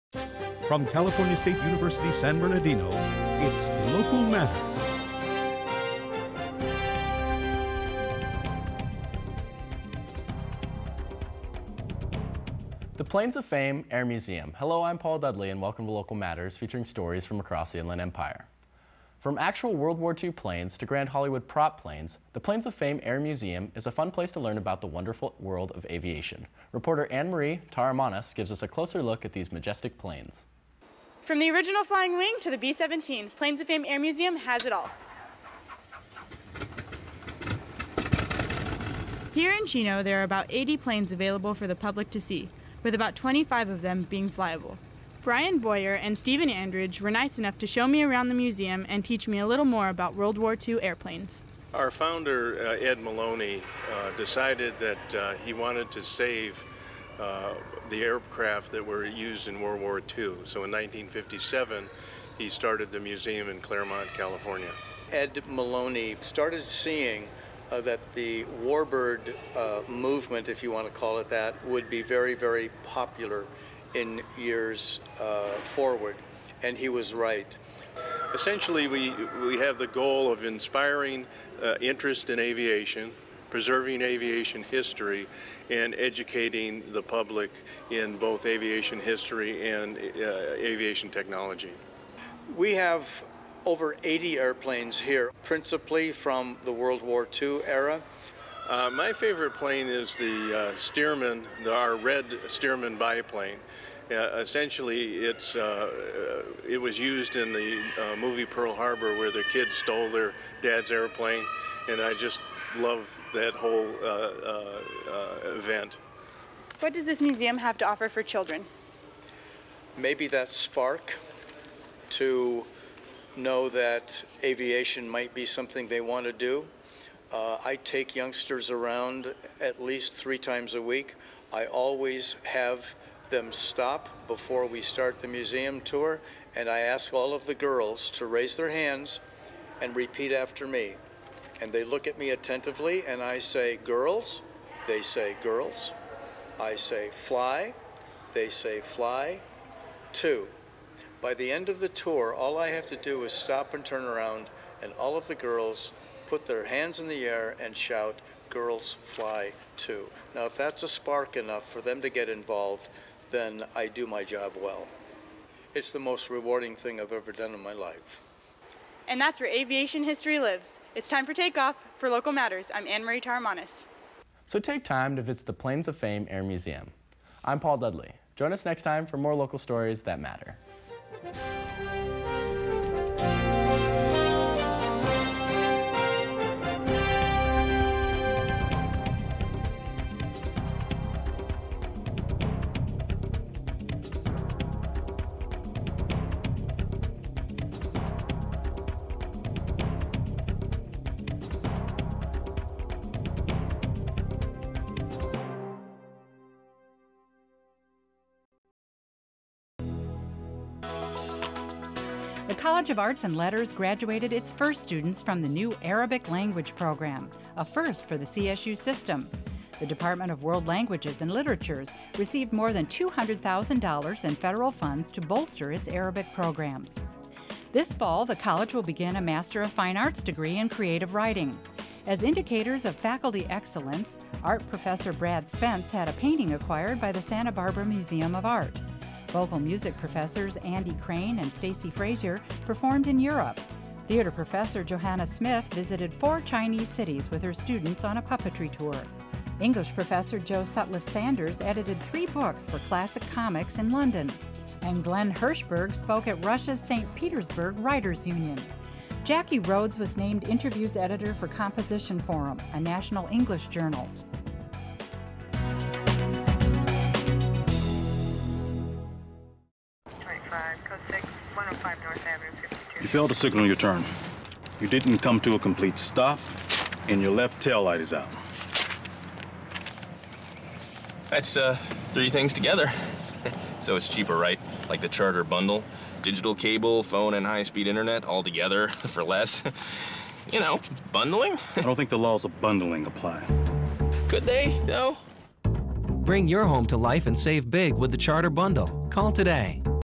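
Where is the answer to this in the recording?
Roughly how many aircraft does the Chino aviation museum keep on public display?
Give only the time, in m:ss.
0:40.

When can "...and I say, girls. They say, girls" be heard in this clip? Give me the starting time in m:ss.
2:23.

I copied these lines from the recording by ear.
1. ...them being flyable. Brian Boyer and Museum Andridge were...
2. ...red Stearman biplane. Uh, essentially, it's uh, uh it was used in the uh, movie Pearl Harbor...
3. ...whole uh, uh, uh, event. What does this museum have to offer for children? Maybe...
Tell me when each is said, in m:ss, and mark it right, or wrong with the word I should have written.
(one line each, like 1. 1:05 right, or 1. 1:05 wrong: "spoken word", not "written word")
1. 0:43 wrong: "Stephen", not "Museum"
2. 1:41 right
3. 1:53 right.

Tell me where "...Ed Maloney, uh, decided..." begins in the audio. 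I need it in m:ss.
0:52.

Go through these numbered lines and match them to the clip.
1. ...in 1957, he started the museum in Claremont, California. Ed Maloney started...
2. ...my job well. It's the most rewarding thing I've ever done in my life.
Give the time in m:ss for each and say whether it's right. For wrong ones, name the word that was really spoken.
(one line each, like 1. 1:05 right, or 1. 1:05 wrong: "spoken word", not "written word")
1. 1:00 right
2. 2:44 right.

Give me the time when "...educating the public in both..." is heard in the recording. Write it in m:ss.
1:25.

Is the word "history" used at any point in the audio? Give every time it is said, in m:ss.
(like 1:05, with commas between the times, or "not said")
1:24, 1:28, 2:50.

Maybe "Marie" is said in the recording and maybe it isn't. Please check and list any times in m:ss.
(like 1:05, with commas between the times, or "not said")
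0:27, 2:52.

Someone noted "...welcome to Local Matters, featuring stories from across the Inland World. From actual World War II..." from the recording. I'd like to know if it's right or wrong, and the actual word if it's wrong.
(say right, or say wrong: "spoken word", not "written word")
wrong: "Empire", not "World".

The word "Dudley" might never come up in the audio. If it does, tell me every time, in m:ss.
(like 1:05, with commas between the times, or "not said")
0:15, 2:57.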